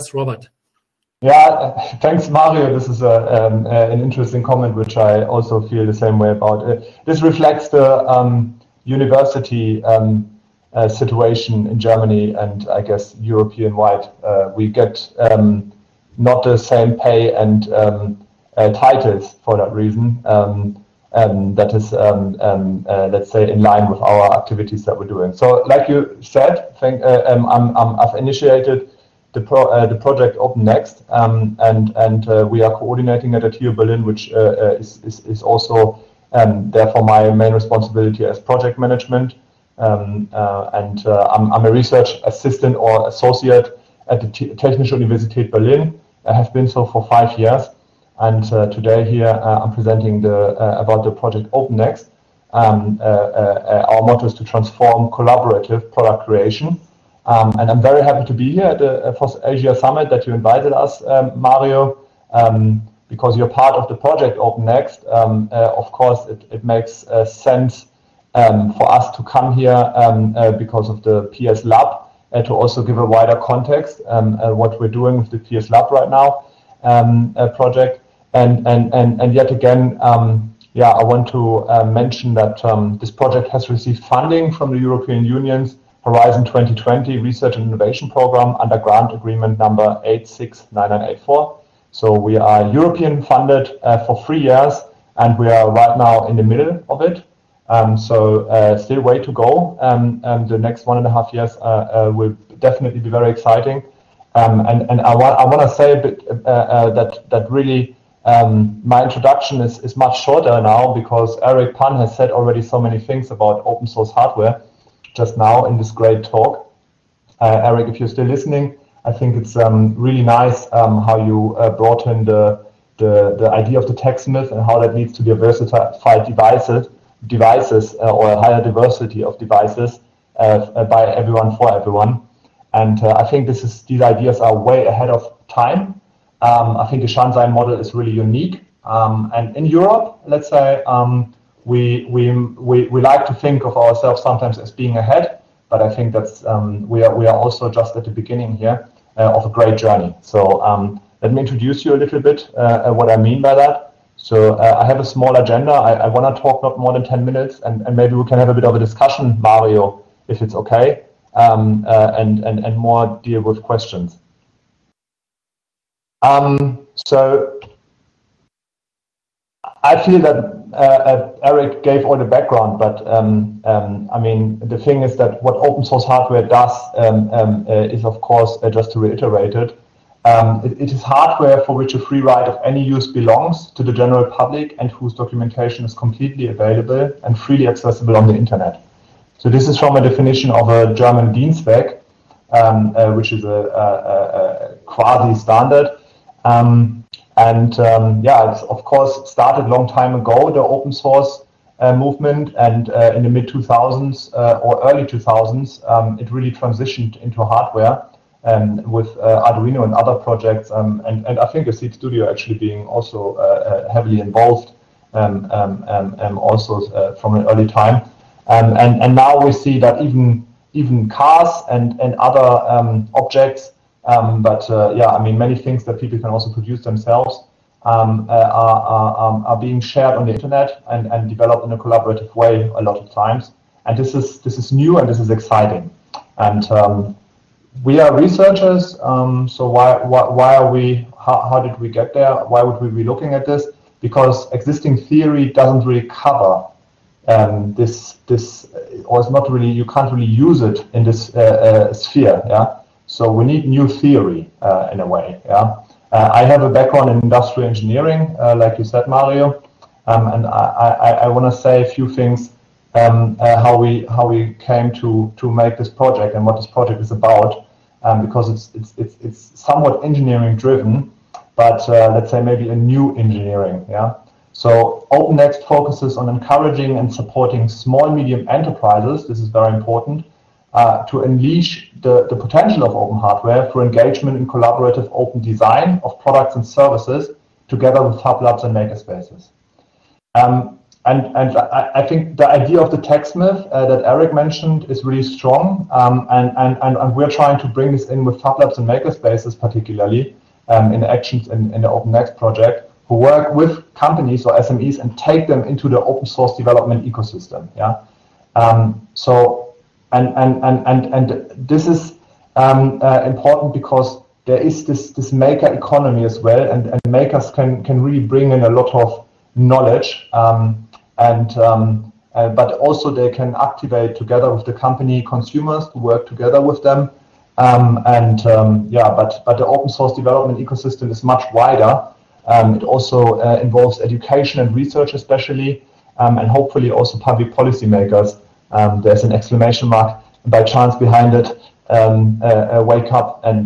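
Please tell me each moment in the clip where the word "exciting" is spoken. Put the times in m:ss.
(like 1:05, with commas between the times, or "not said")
1:43, 3:55.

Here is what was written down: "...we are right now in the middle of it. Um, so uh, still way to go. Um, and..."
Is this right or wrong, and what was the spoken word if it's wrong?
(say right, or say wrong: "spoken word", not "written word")
right.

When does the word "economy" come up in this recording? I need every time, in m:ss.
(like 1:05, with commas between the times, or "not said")
5:15.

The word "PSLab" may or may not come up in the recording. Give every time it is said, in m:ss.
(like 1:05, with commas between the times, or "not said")
1:11, 1:15.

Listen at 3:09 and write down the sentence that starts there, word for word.
So this is from a definition of a German DIN SPEC, um, uh, which is a, a, a, a quasi-standard.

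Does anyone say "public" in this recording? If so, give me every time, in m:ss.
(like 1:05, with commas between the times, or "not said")
3:04, 5:37.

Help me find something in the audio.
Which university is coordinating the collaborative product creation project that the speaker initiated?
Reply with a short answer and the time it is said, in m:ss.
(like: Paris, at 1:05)
TU Berlin, at 0:33.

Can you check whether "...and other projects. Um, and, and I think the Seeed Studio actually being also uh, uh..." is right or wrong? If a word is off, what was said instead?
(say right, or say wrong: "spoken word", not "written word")
right.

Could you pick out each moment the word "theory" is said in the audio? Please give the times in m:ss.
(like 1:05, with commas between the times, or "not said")
4:04, 4:13.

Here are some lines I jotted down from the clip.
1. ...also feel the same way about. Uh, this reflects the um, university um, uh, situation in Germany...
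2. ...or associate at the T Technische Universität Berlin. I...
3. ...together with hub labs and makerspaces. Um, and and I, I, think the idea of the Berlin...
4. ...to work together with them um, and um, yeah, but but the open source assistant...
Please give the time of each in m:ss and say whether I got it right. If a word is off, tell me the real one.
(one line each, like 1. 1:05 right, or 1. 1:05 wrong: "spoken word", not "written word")
1. 0:05 right
2. 0:42 right
3. 4:47 wrong: "TechSmith", not "Berlin"
4. 5:25 wrong: "development", not "assistant".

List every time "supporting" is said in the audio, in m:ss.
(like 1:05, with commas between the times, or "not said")
4:37.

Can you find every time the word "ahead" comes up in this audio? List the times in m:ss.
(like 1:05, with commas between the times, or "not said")
2:14, 2:24.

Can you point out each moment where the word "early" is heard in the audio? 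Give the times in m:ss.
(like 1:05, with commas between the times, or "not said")
3:24, 3:37.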